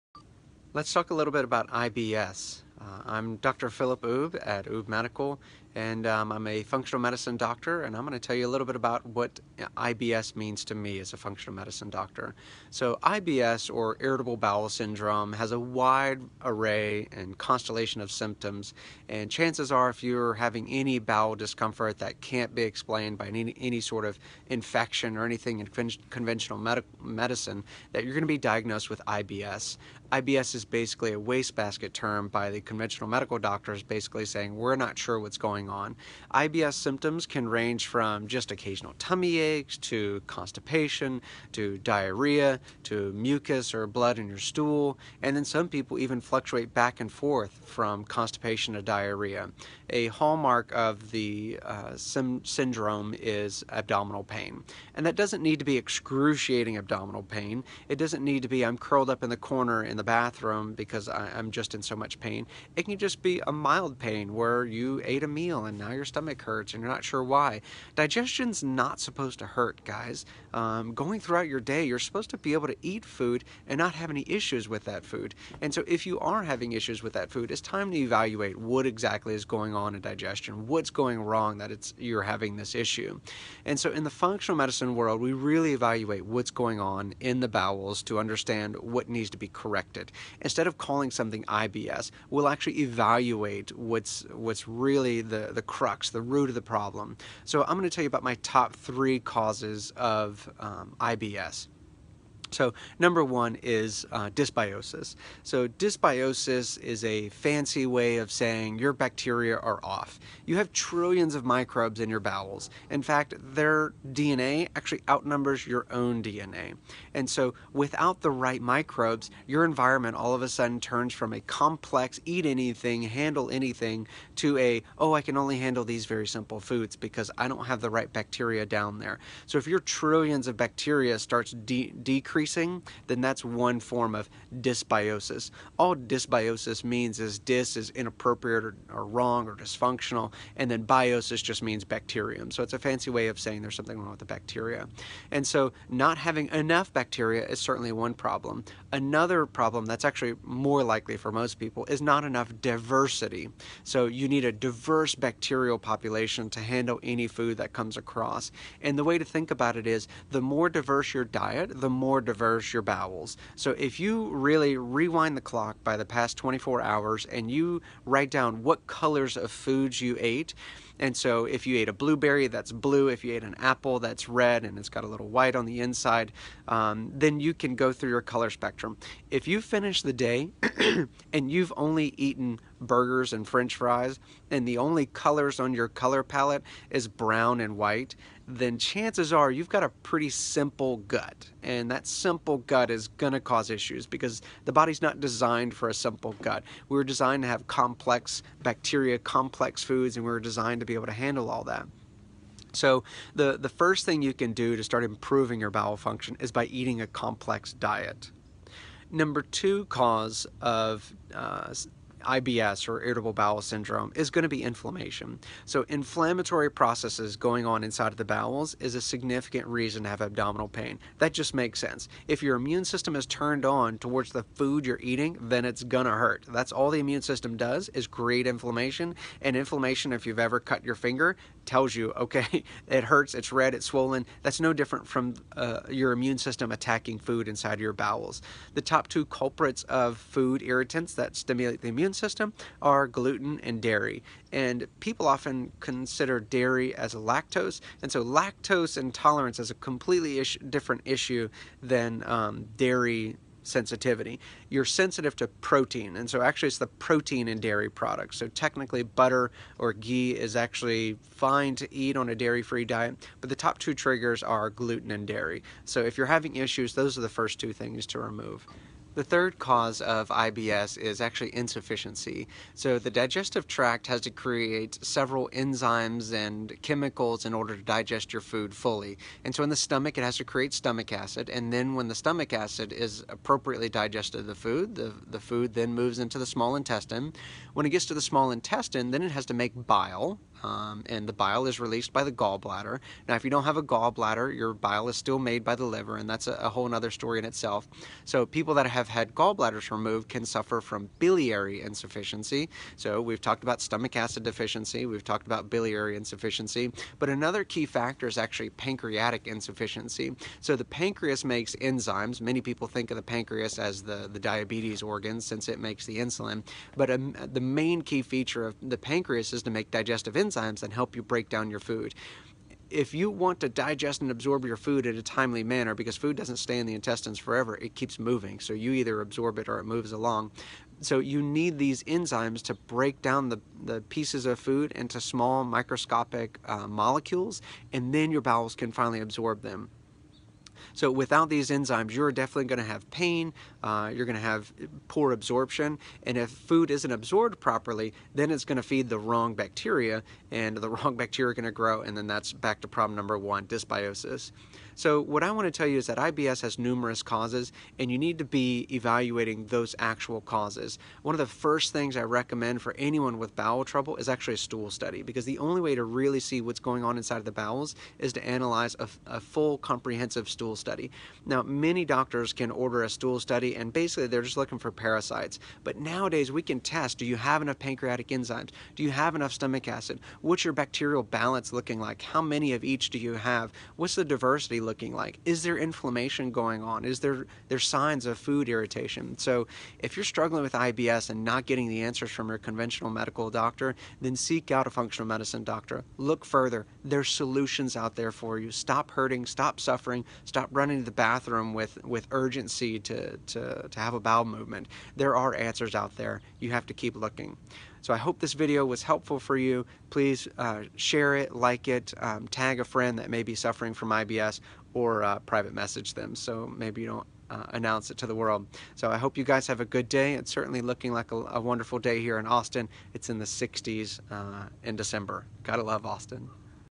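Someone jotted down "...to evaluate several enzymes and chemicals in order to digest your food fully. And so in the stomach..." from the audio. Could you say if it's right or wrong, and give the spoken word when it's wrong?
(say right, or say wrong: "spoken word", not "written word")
wrong: "create", not "evaluate".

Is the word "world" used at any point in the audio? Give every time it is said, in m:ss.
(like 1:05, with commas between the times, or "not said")
1:24, 6:58.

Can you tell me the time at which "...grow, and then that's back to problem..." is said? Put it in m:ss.
5:51.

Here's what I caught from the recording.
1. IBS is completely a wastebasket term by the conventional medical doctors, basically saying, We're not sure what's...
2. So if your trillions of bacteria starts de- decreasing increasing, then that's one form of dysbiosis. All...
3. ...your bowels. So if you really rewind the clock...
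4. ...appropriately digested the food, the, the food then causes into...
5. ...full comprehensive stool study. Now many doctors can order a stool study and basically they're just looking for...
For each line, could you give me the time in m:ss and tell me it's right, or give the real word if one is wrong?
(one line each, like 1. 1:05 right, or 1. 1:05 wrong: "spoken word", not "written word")
1. 0:30 wrong: "basically", not "completely"
2. 2:09 right
3. 2:42 right
4. 4:43 wrong: "moves", not "causes"
5. 6:09 right.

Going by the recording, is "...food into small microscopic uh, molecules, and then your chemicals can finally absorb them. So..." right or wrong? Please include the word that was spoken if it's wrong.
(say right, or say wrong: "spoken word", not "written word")
wrong: "bowels", not "chemicals".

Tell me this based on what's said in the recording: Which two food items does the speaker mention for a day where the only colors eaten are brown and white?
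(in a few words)
Burgers and french fries.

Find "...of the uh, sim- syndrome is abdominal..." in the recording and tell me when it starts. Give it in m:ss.
0:50.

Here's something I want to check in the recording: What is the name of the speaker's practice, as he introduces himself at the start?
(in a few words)
Oubre Medical.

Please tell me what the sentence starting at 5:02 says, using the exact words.
So, we've talked about stomach acid deficiency, we've talked about biliary insufficiency, but another key factor is actually pancreatic insufficiency.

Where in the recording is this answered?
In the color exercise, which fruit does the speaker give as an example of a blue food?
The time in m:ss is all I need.
2:51.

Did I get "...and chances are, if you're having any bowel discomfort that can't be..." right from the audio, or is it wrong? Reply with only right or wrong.
right.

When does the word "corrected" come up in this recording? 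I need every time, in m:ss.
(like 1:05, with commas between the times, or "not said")
1:29.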